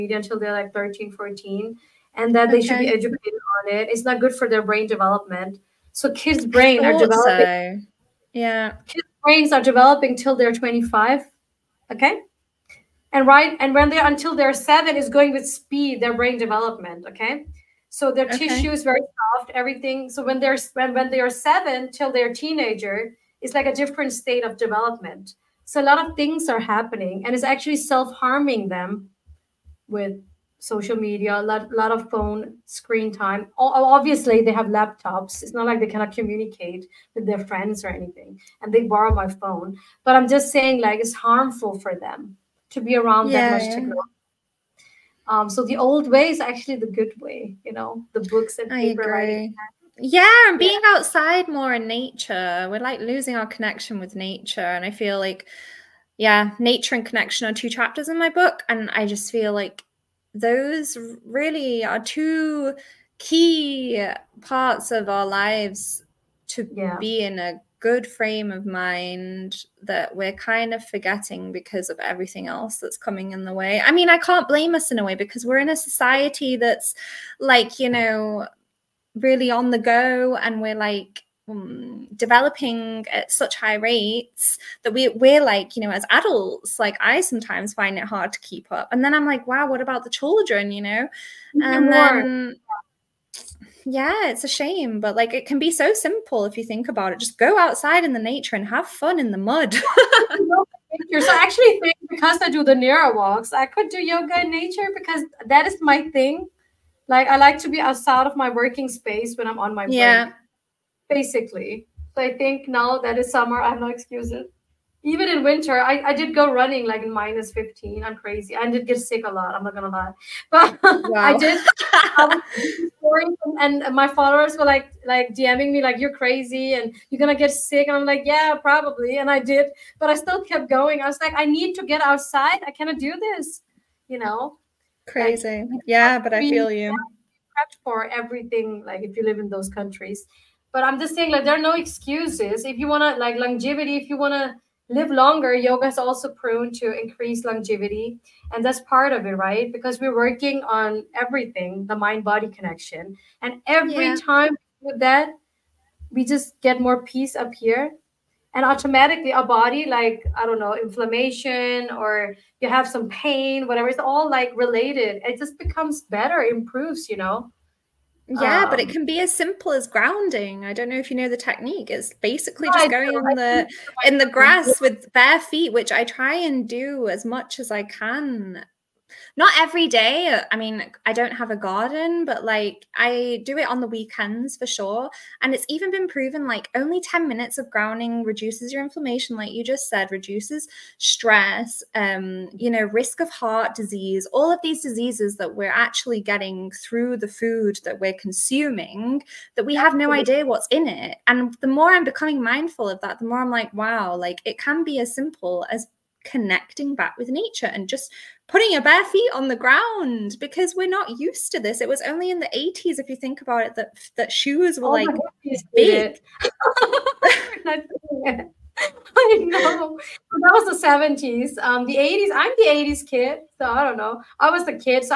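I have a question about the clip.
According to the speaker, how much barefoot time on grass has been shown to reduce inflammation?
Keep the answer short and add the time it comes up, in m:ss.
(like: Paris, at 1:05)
10 minutes, at 3:07.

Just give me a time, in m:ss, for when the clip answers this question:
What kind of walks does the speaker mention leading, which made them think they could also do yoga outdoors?
1:42.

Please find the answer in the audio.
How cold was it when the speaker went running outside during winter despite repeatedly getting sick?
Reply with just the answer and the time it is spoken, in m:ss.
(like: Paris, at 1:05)
-15, at 1:57.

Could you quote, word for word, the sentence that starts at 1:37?
Just go outside in the nature and have fun in the mud.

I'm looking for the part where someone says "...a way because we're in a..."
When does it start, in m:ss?
1:14.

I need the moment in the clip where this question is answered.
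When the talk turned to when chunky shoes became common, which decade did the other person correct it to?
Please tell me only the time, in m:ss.
3:40.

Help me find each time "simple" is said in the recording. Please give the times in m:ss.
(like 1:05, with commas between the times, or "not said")
1:35, 2:49, 3:25.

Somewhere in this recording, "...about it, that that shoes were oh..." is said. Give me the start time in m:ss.
3:33.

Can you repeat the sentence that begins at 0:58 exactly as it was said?
And I just feel like those really are two key parts of our lives to yeah.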